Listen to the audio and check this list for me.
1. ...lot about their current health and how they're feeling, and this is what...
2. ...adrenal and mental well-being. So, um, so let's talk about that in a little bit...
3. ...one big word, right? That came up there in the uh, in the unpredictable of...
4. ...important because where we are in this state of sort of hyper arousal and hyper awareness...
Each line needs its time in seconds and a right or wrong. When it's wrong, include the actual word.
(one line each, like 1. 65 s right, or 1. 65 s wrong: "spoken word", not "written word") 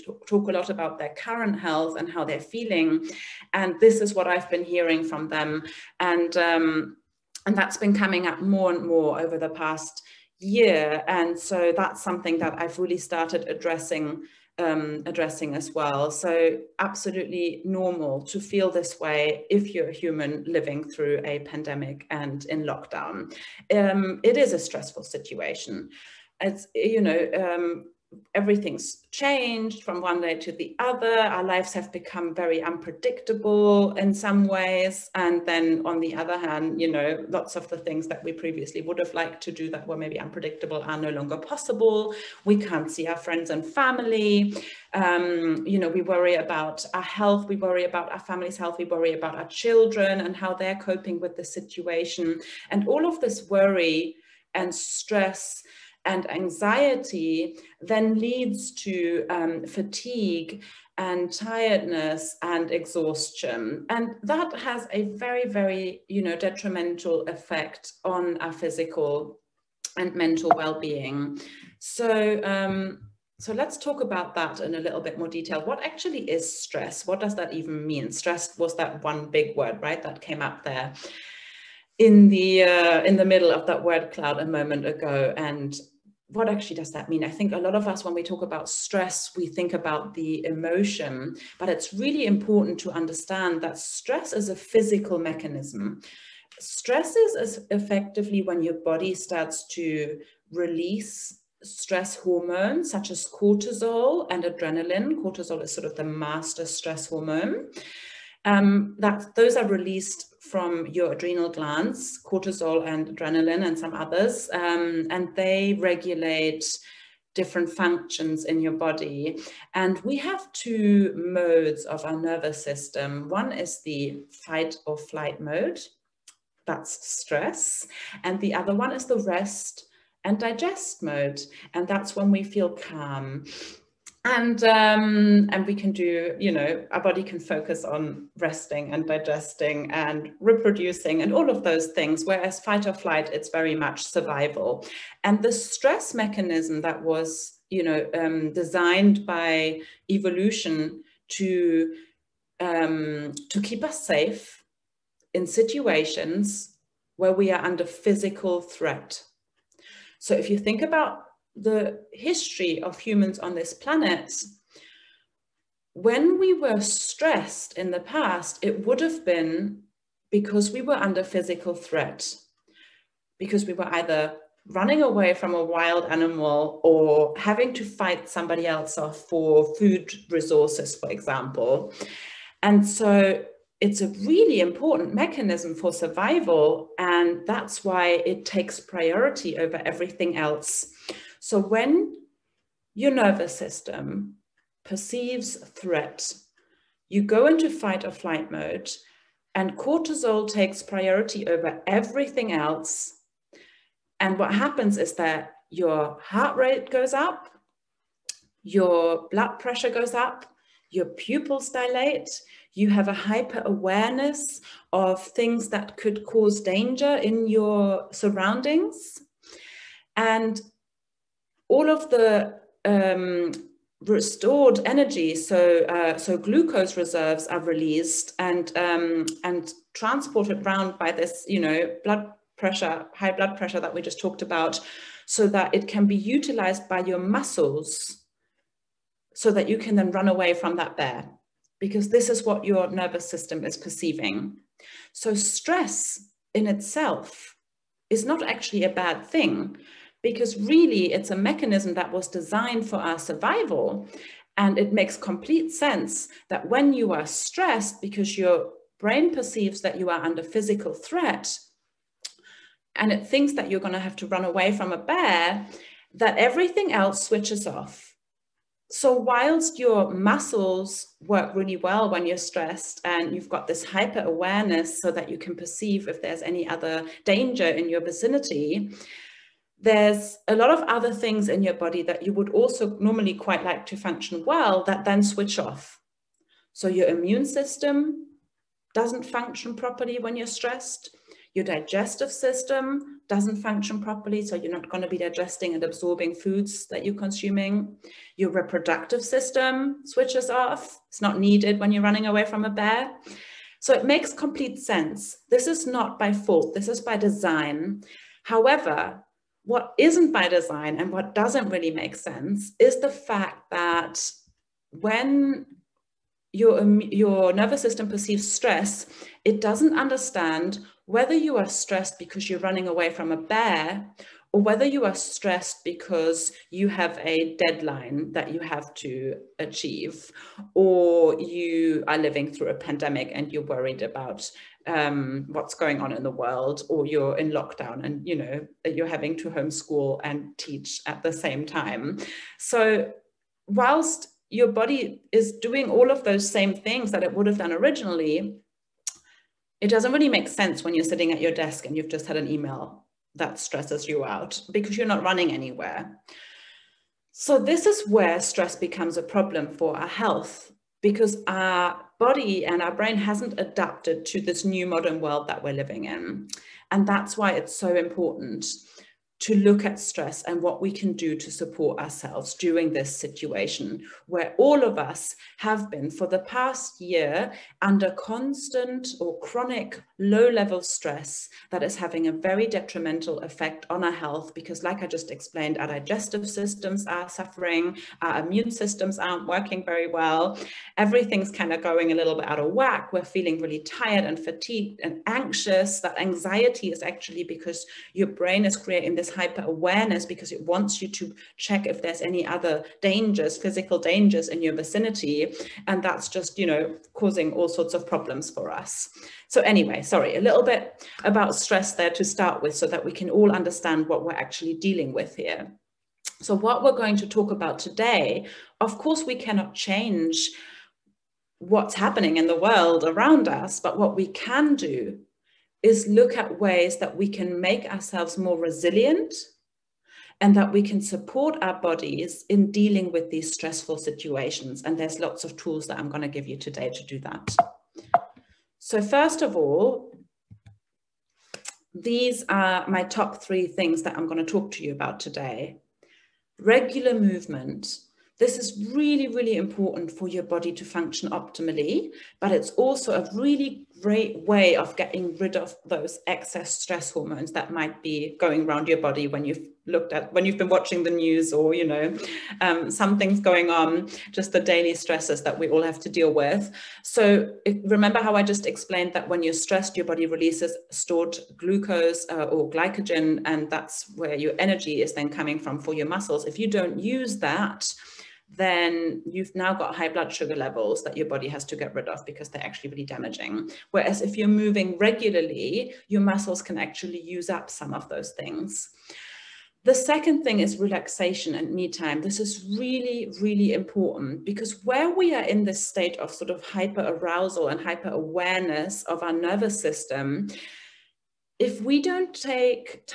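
1. 0 s right
2. 68 s wrong: "physical", not "adrenal"
3. 79 s wrong: "middle", not "unpredictable"
4. 493 s right.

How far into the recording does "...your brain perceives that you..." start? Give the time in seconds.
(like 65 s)
258 s.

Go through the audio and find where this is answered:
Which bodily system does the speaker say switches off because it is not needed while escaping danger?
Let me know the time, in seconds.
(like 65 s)
298 s.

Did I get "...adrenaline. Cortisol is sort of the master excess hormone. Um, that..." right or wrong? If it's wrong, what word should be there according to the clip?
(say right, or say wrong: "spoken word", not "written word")
wrong: "stress", not "excess".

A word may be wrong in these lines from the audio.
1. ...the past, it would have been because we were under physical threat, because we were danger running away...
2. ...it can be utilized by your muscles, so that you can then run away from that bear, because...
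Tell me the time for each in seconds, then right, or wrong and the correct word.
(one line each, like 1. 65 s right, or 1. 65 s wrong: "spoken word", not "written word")
1. 167 s wrong: "either", not "danger"
2. 235 s right.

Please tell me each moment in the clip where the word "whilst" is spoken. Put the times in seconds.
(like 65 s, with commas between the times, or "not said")
269 s, 343 s.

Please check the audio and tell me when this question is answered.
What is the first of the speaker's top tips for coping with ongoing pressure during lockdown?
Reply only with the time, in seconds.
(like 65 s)
446 s.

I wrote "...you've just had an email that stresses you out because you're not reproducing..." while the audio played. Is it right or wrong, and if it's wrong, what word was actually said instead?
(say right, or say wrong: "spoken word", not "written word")
wrong: "running", not "reproducing".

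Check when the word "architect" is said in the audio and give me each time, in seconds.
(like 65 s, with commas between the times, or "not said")
not said.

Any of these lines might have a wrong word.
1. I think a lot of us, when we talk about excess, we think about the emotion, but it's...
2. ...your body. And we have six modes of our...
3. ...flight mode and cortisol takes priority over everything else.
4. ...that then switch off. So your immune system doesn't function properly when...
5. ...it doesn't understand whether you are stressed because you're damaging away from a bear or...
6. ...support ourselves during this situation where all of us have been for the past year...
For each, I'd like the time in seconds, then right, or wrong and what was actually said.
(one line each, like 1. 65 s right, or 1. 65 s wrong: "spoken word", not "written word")
1. 87 s wrong: "stress", not "excess"
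2. 118 s wrong: "two", not "six"
3. 198 s right
4. 284 s right
5. 319 s wrong: "running", not "damaging"
6. 371 s right.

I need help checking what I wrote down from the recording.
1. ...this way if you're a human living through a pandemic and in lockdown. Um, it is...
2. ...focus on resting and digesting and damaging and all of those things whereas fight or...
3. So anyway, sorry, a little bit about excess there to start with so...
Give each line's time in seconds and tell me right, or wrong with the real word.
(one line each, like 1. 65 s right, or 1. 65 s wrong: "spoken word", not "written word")
1. 18 s right
2. 137 s wrong: "reproducing", not "damaging"
3. 409 s wrong: "stress", not "excess".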